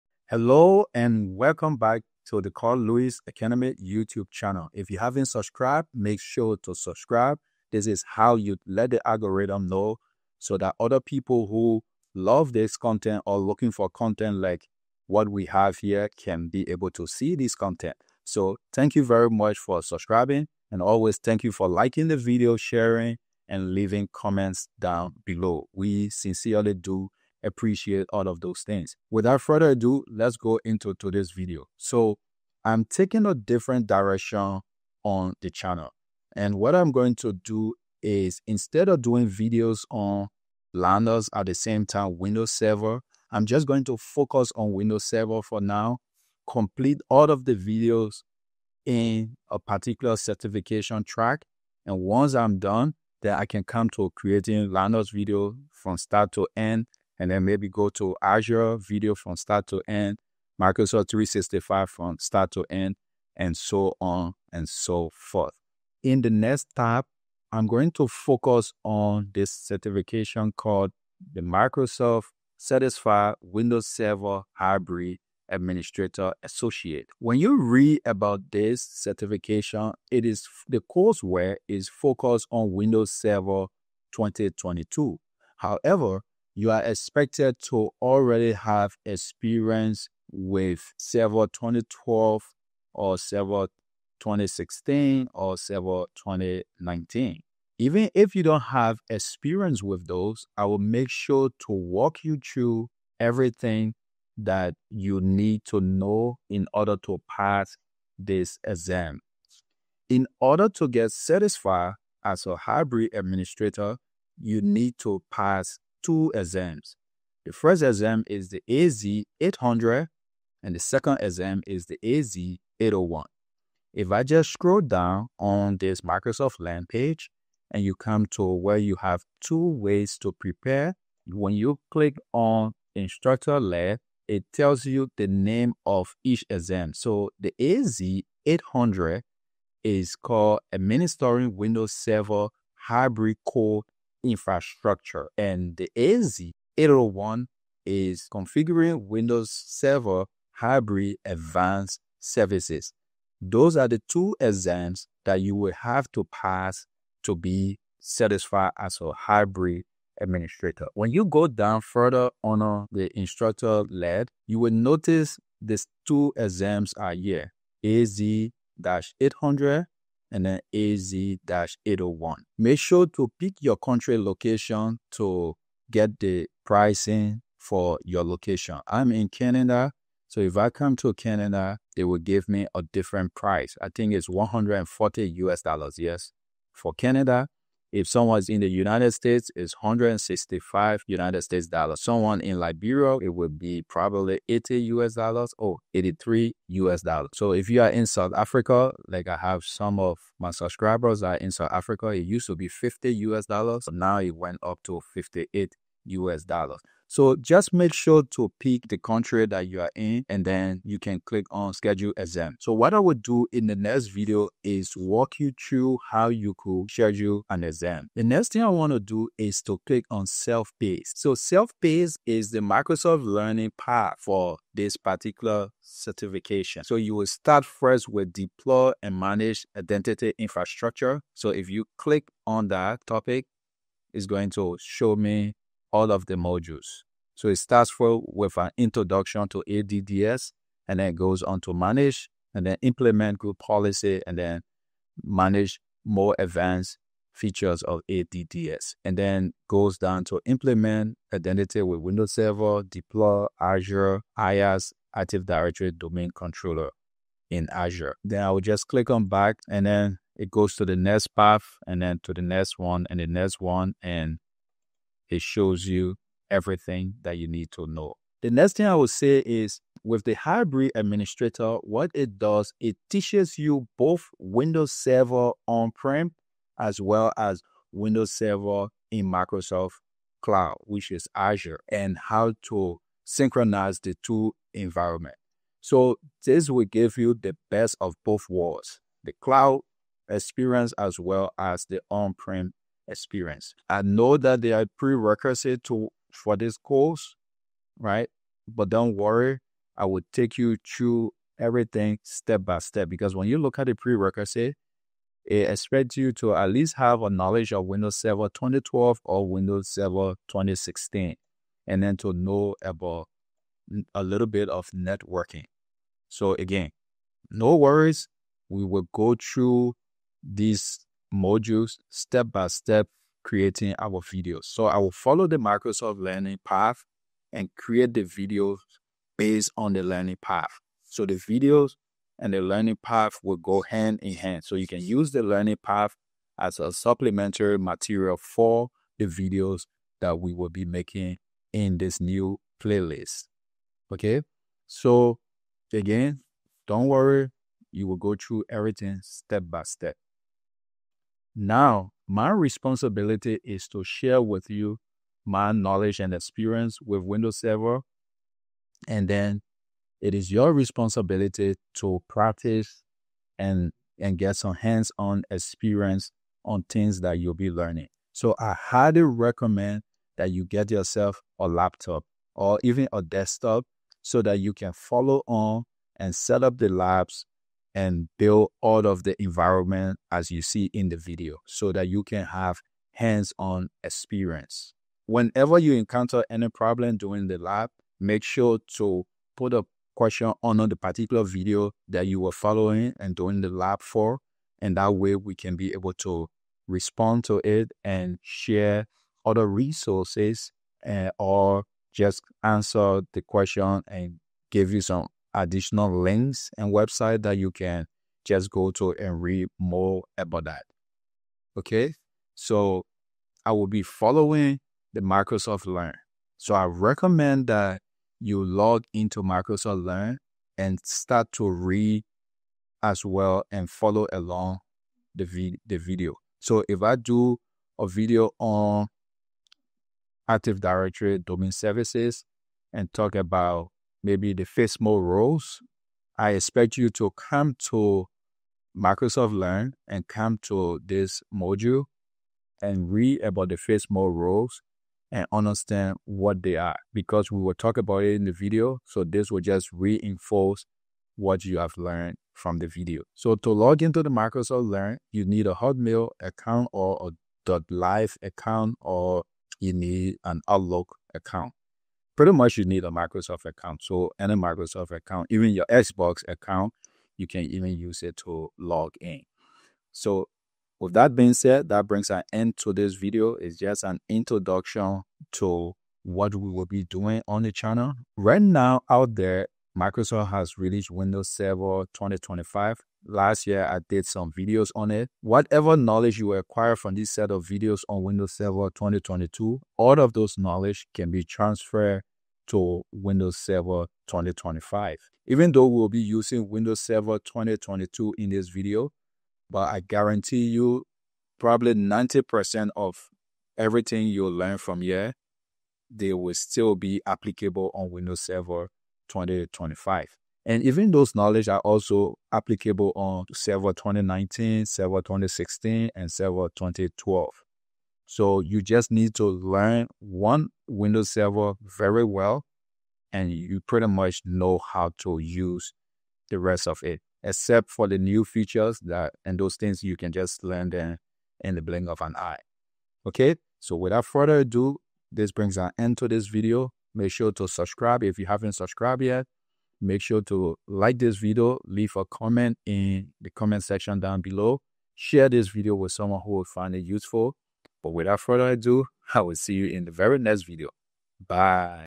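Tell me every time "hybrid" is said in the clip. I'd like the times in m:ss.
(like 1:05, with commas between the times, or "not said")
1:14, 1:52, 2:22, 2:30, 2:39, 4:30.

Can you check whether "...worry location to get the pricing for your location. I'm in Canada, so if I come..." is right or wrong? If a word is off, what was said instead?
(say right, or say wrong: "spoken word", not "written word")
wrong: "country", not "worry".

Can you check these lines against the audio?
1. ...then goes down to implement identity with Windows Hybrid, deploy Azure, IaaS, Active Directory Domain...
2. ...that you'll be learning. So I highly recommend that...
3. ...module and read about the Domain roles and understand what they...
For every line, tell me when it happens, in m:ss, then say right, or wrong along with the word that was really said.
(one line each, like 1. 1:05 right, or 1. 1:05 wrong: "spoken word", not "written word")
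1. 4:09 wrong: "Server", not "Hybrid"
2. 6:07 right
3. 7:21 wrong: "FSMO", not "Domain".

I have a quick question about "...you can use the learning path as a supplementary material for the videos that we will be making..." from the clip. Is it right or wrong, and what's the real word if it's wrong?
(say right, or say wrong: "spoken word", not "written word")
right.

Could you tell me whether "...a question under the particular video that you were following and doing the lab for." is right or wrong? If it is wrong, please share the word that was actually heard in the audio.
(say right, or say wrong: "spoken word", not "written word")
right.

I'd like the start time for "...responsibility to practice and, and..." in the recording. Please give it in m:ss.
6:00.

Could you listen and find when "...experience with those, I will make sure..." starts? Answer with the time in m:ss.
1:39.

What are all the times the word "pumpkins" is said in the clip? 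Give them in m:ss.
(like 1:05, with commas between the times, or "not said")
not said.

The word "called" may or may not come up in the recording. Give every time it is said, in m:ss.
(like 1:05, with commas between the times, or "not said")
1:10, 2:20.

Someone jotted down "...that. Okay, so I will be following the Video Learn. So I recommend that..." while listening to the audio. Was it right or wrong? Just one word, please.
wrong.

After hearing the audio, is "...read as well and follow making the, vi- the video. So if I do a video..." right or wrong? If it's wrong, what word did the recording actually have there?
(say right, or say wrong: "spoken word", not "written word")
wrong: "along", not "making".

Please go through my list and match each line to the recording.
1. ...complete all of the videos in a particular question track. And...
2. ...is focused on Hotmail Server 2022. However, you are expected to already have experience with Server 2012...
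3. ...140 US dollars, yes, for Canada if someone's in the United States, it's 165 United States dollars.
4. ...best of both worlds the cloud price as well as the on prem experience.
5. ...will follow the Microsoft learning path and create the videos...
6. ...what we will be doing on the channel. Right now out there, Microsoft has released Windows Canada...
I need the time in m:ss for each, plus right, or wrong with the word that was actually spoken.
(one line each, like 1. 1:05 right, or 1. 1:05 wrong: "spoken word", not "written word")
1. 0:46 wrong: "certification", not "question"
2. 1:21 wrong: "Windows", not "Hotmail"
3. 3:04 right
4. 4:47 wrong: "experience", not "price"
5. 5:24 right
6. 7:56 wrong: "Server", not "Canada".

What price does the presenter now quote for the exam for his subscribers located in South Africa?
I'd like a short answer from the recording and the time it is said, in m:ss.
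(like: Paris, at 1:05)
58 US dollars, at 3:25.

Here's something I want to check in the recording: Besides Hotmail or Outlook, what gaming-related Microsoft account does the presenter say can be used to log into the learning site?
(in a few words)
Xbox account.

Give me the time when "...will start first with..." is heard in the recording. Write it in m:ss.
3:47.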